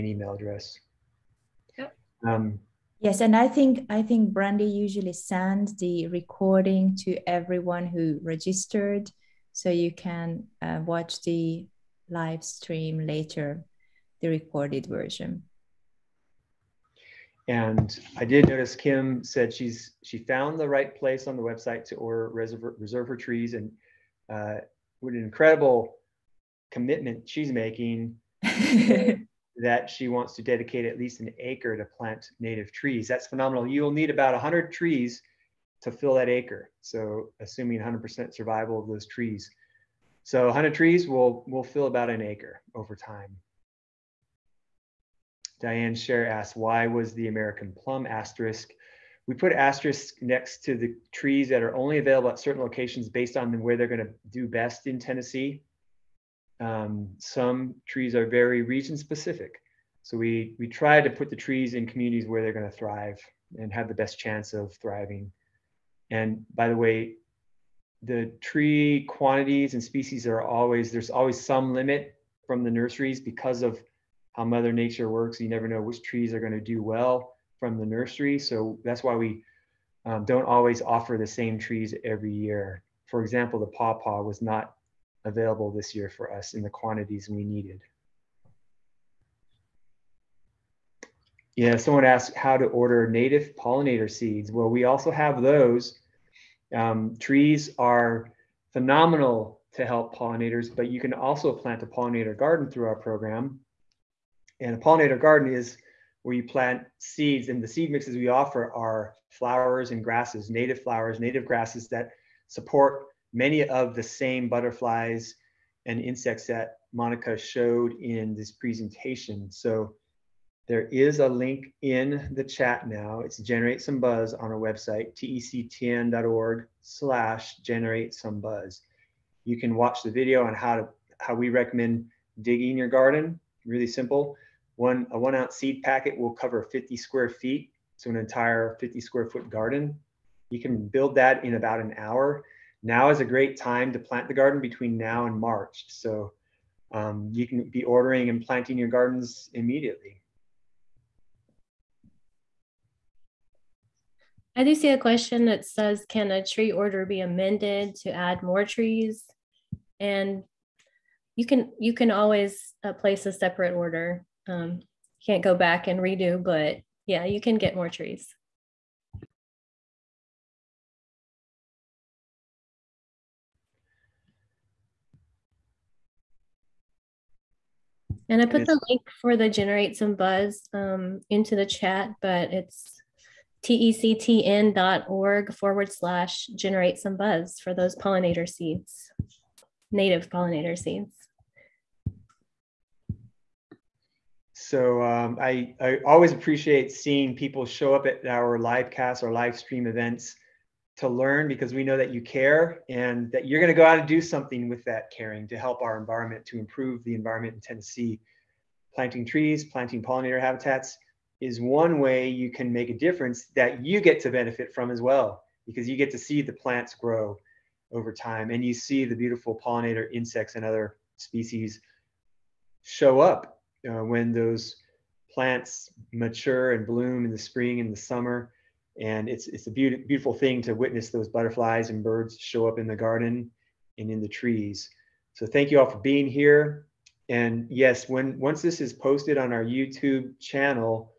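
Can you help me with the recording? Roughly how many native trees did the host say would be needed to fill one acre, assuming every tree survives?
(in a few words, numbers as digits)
100.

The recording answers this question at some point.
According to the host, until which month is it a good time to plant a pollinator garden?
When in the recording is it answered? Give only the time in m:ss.
2:25.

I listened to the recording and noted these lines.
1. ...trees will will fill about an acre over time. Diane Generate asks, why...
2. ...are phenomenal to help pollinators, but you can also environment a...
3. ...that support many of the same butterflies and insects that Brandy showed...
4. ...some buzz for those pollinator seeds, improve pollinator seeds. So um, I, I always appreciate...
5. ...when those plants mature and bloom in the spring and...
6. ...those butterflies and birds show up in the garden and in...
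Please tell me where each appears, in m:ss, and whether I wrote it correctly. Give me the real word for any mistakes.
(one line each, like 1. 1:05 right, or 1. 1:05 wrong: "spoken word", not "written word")
1. 0:40 wrong: "Scher", not "Generate"
2. 1:37 wrong: "plant", not "environment"
3. 1:51 wrong: "Monica", not "Brandy"
4. 3:06 wrong: "native", not "improve"
5. 3:44 right
6. 3:51 right.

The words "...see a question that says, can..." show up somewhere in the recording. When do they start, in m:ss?
2:34.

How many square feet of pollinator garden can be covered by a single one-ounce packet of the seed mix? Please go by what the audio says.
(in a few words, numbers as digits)
50.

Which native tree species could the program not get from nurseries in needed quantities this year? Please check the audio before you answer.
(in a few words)
pawpaw.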